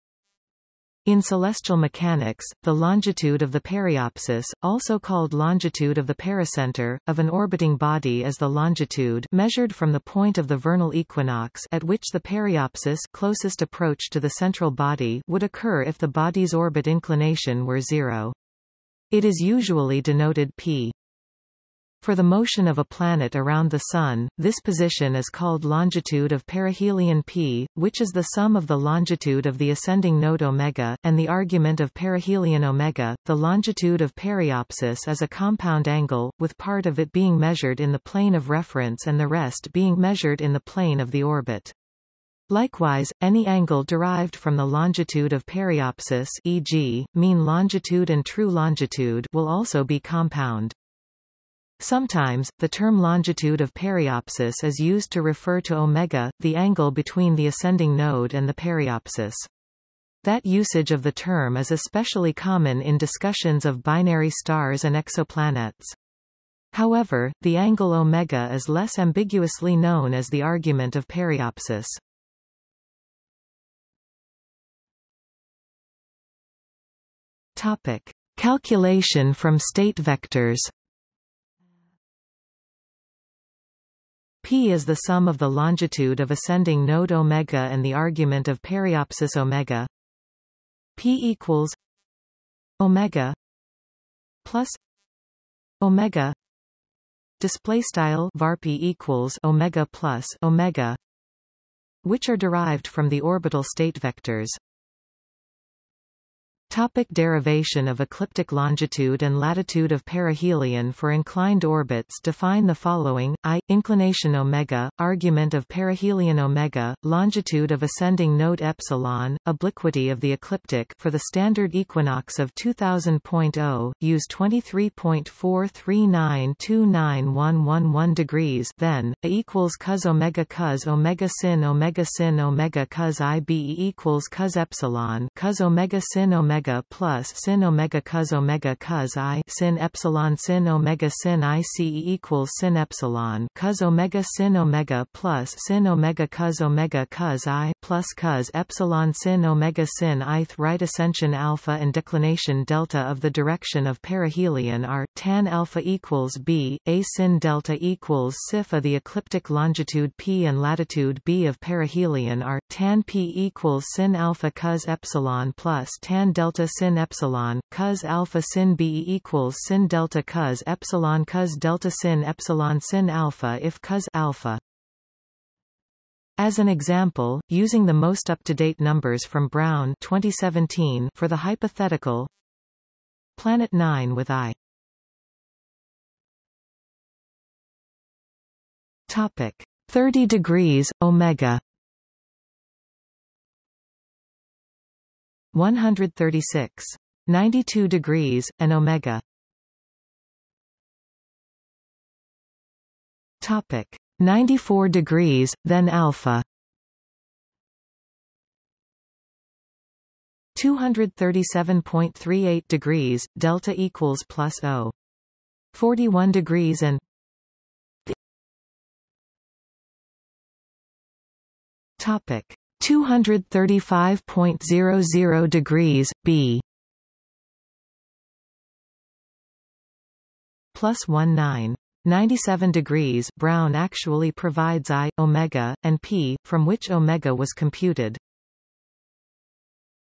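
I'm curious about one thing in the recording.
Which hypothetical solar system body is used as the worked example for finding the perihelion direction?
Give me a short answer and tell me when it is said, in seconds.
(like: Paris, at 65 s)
Planet 9, at 183 s.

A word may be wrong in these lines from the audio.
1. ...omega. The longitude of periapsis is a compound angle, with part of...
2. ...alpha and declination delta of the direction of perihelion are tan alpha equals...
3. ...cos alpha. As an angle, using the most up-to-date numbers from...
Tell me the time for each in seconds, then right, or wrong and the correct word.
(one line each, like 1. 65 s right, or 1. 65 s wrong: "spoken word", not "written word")
1. 32 s right
2. 151 s right
3. 173 s wrong: "example", not "angle".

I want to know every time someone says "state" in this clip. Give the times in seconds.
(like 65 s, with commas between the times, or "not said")
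79 s, 103 s.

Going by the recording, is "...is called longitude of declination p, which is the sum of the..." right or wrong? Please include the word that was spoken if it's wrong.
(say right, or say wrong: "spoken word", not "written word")
wrong: "perihelion", not "declination".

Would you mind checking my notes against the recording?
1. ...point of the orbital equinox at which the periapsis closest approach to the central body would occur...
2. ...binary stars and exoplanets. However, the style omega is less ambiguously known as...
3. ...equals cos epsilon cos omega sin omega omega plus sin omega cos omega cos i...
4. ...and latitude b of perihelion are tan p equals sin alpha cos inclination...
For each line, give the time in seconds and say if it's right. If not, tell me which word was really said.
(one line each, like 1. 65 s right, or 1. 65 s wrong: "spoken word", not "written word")
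1. 9 s wrong: "vernal", not "orbital"
2. 63 s wrong: "angle", not "style"
3. 133 s right
4. 160 s wrong: "epsilon", not "inclination".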